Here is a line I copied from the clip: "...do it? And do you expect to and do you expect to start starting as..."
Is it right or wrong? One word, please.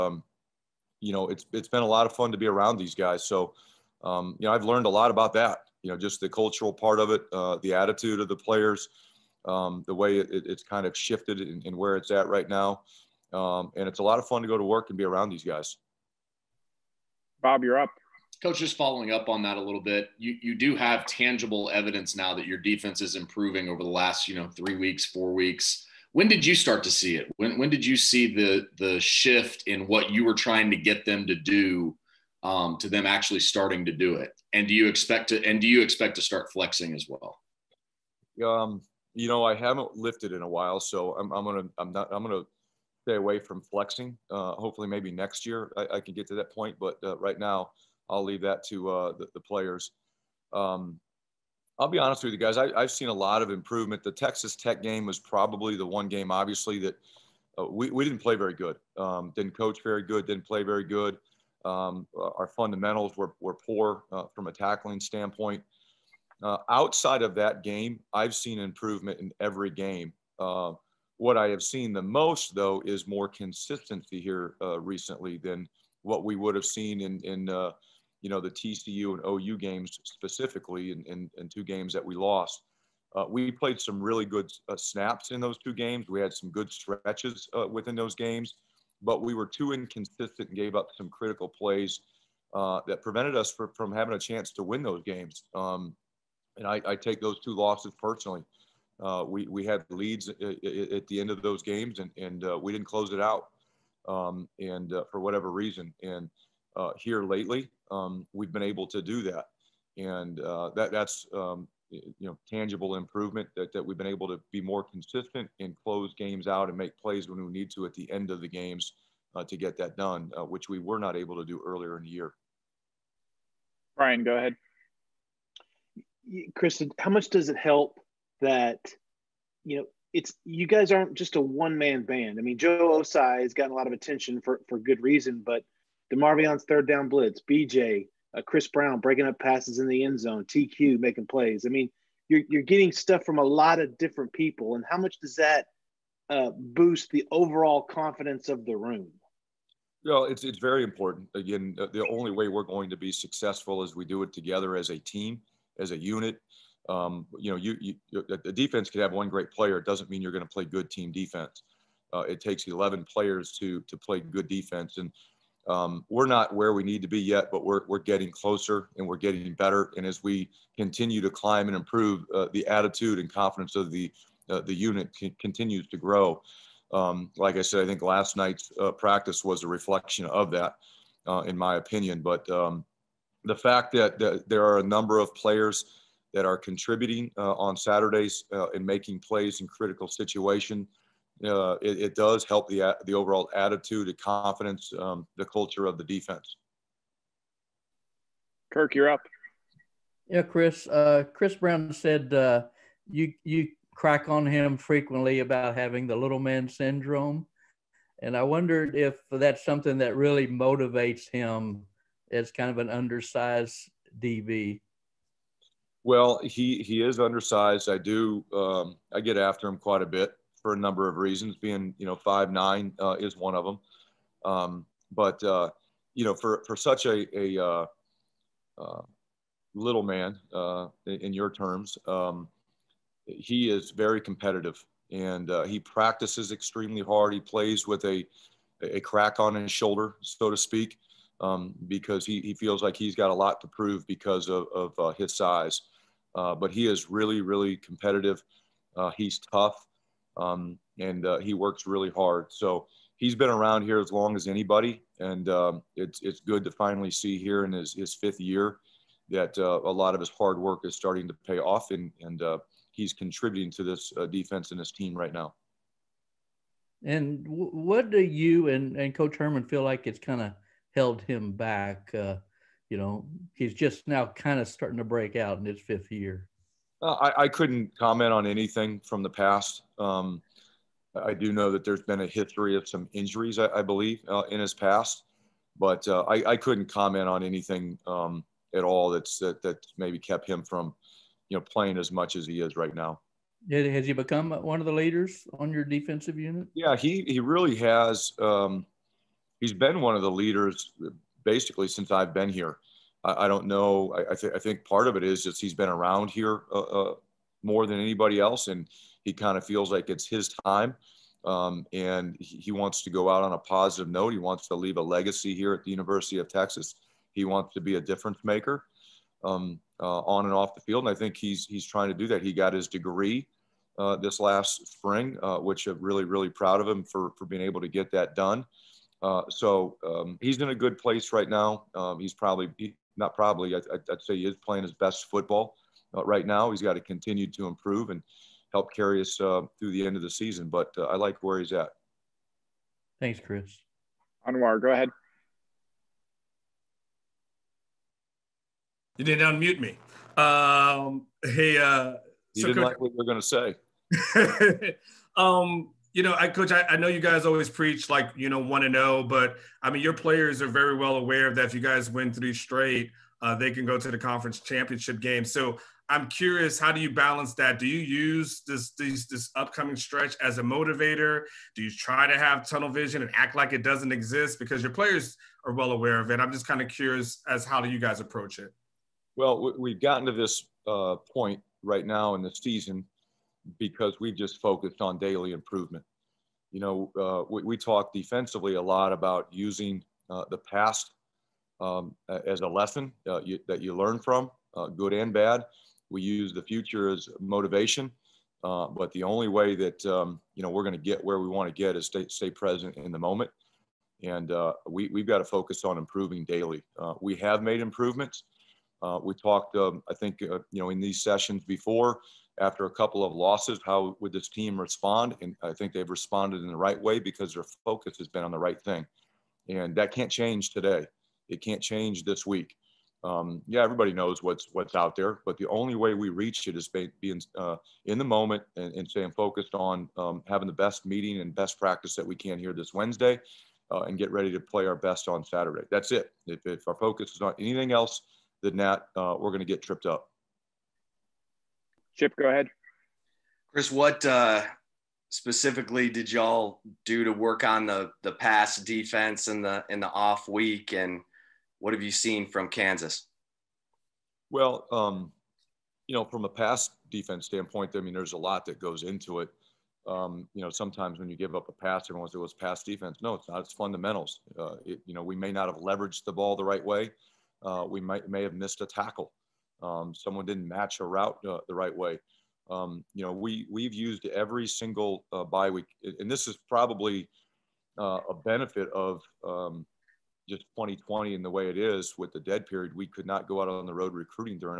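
wrong.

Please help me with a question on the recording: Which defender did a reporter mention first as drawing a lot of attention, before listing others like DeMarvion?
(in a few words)
Joe Ossai.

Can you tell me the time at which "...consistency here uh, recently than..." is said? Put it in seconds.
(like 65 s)
73 s.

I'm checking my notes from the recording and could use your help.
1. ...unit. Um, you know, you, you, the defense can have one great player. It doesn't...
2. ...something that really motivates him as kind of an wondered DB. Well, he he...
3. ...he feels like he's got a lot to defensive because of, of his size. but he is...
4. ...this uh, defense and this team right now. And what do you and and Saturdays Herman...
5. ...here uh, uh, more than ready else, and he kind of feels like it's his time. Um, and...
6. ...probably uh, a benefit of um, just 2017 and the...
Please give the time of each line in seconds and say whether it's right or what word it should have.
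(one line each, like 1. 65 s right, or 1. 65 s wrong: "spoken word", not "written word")
1. 155 s right
2. 209 s wrong: "undersized", not "wondered"
3. 242 s wrong: "prove", not "defensive"
4. 263 s wrong: "Coach", not "Saturdays"
5. 306 s wrong: "anybody", not "ready"
6. 476 s wrong: "2020", not "2017".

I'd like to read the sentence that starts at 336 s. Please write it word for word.
He's got to continue to improve and help carry us uh, through the end of the season.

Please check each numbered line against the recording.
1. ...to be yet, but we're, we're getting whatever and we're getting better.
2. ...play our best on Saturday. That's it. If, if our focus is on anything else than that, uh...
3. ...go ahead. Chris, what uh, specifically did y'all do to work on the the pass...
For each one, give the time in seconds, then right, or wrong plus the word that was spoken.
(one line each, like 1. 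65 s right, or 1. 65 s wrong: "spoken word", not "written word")
1. 167 s wrong: "closer", not "whatever"
2. 434 s right
3. 442 s right.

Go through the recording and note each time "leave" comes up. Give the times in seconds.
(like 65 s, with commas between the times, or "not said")
48 s, 314 s.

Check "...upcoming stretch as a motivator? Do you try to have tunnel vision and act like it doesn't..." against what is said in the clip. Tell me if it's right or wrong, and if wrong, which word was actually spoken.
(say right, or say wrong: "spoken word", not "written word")
right.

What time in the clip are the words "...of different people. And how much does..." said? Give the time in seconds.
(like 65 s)
143 s.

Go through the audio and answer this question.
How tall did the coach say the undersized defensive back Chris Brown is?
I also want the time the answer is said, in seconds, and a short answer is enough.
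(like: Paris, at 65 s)
5'9", at 222 s.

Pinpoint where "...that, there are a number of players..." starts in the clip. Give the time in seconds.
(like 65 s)
184 s.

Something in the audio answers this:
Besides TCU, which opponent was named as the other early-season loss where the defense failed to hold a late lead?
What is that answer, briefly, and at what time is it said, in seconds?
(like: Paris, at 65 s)
OU, at 79 s.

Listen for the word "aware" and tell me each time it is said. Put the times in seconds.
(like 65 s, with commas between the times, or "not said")
361 s, 375 s.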